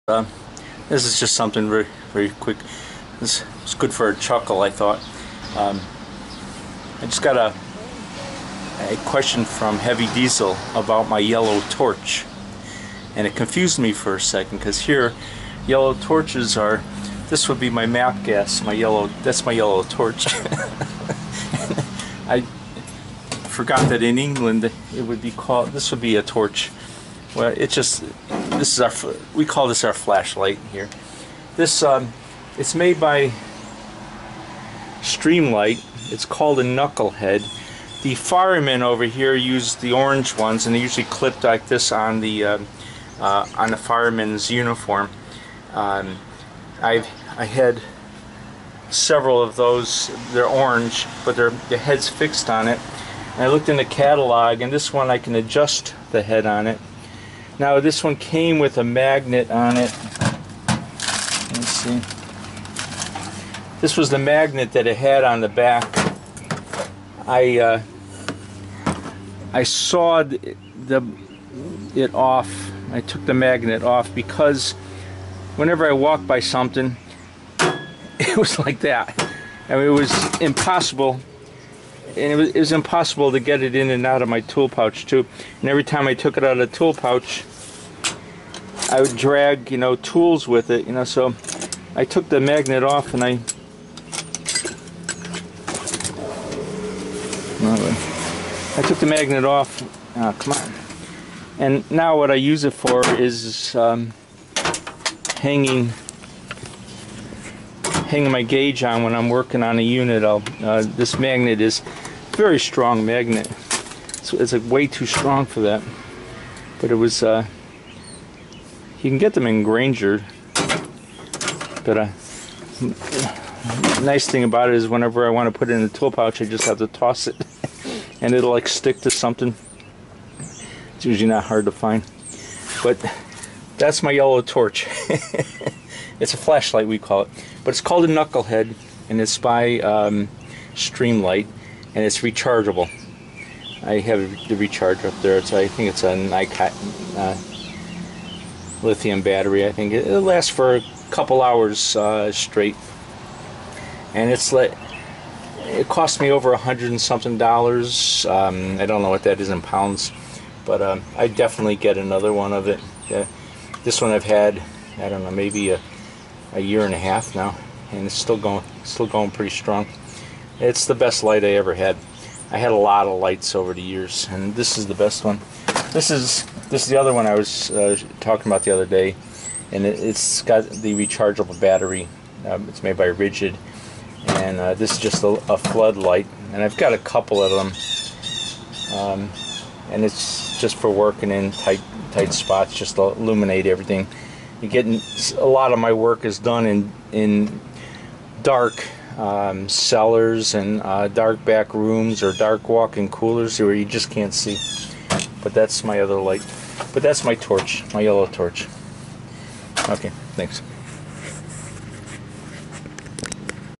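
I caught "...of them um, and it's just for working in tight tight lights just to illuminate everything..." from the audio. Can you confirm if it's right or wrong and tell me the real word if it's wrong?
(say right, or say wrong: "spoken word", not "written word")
wrong: "spots", not "lights".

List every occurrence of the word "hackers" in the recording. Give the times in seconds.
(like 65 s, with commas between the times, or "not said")
not said.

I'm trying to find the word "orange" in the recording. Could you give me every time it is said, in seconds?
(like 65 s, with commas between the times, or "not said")
39 s, 50 s.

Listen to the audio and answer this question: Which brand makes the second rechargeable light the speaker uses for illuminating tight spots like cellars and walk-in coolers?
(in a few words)
Ridgid.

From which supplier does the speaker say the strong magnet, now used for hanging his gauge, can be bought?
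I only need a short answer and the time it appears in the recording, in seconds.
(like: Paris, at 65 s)
Grainger, at 119 s.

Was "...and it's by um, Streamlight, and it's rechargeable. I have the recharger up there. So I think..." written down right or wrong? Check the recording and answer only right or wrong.
right.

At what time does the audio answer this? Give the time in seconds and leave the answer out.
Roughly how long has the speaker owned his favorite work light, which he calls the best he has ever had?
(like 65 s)
166 s.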